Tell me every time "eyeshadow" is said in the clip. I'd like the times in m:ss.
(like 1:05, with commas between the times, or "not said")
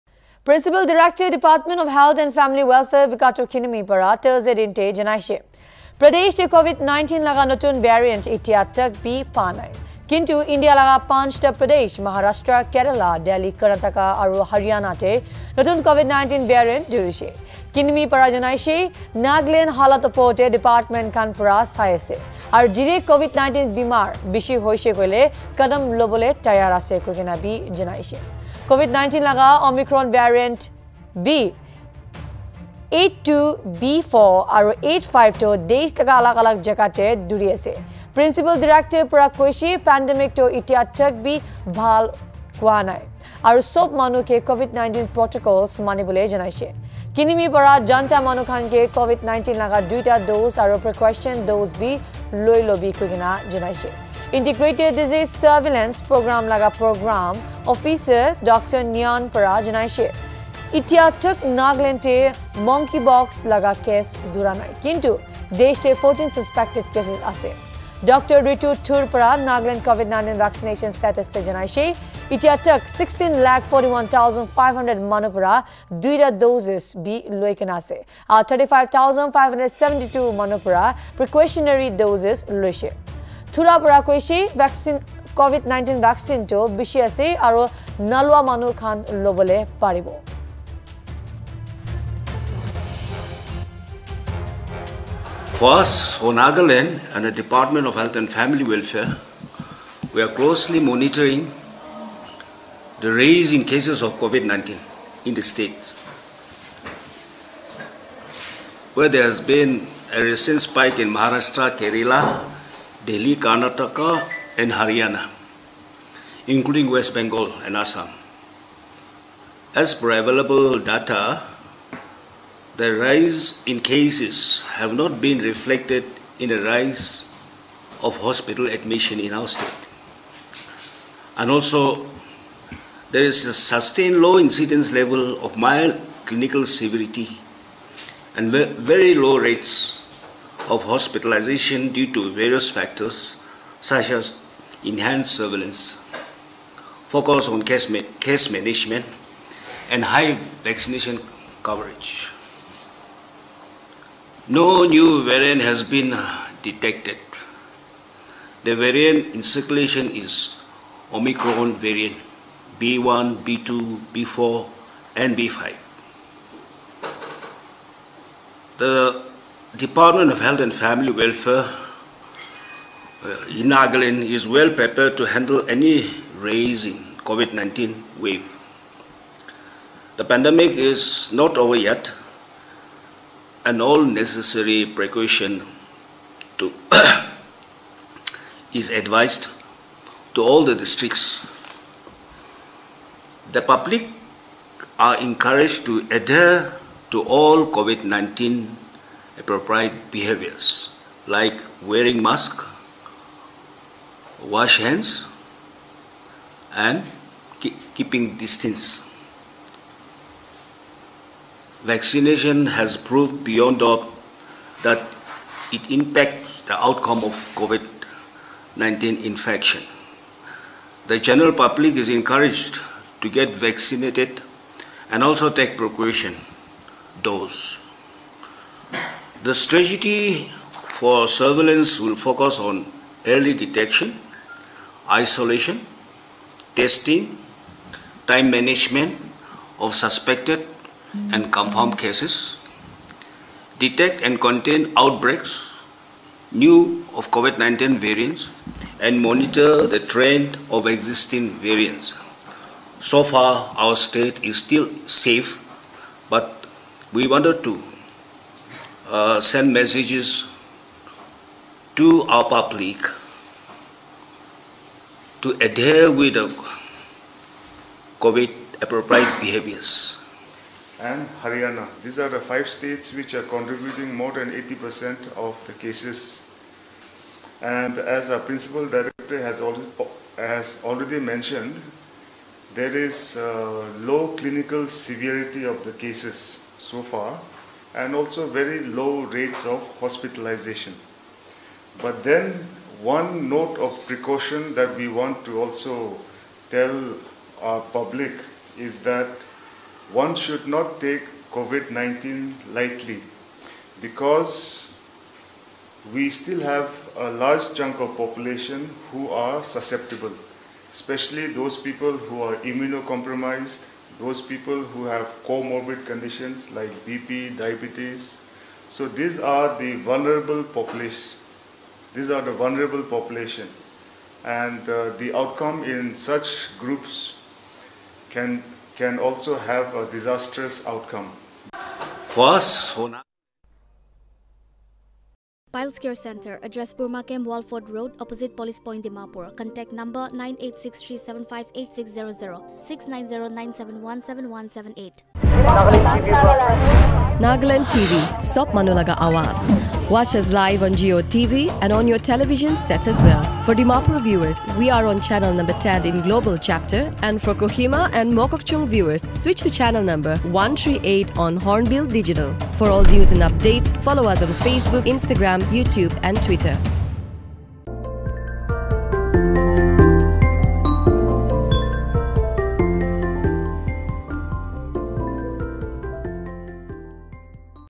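not said.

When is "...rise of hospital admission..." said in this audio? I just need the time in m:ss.
2:06.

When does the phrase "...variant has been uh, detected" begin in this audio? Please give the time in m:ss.
2:35.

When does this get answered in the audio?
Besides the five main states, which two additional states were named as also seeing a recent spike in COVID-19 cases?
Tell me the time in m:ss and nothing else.
1:56.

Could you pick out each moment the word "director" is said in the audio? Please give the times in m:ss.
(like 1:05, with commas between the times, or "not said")
0:00, 4:38.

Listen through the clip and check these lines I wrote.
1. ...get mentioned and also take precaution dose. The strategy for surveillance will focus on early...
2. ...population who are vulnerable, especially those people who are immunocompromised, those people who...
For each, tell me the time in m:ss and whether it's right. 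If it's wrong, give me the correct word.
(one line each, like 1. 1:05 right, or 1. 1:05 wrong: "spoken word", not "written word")
1. 3:43 wrong: "vaccinated", not "mentioned"
2. 5:08 wrong: "susceptible", not "vulnerable".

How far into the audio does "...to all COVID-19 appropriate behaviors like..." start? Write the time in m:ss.
3:17.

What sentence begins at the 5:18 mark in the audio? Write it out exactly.
So these are the vulnerable population.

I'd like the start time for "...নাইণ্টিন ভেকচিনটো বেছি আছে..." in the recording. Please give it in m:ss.
1:25.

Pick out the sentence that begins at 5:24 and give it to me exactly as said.
And uh, the outcome in such groups can, can also have a disastrous outcome.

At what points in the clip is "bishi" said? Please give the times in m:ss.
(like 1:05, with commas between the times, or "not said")
0:24.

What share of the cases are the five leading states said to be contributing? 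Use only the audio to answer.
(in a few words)
More than 80%.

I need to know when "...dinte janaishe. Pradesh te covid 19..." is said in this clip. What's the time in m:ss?
0:04.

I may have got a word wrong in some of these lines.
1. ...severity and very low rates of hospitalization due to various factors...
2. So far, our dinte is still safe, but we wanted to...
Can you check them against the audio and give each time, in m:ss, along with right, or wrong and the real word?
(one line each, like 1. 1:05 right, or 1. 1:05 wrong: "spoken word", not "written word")
1. 2:16 right
2. 4:12 wrong: "state", not "dinte".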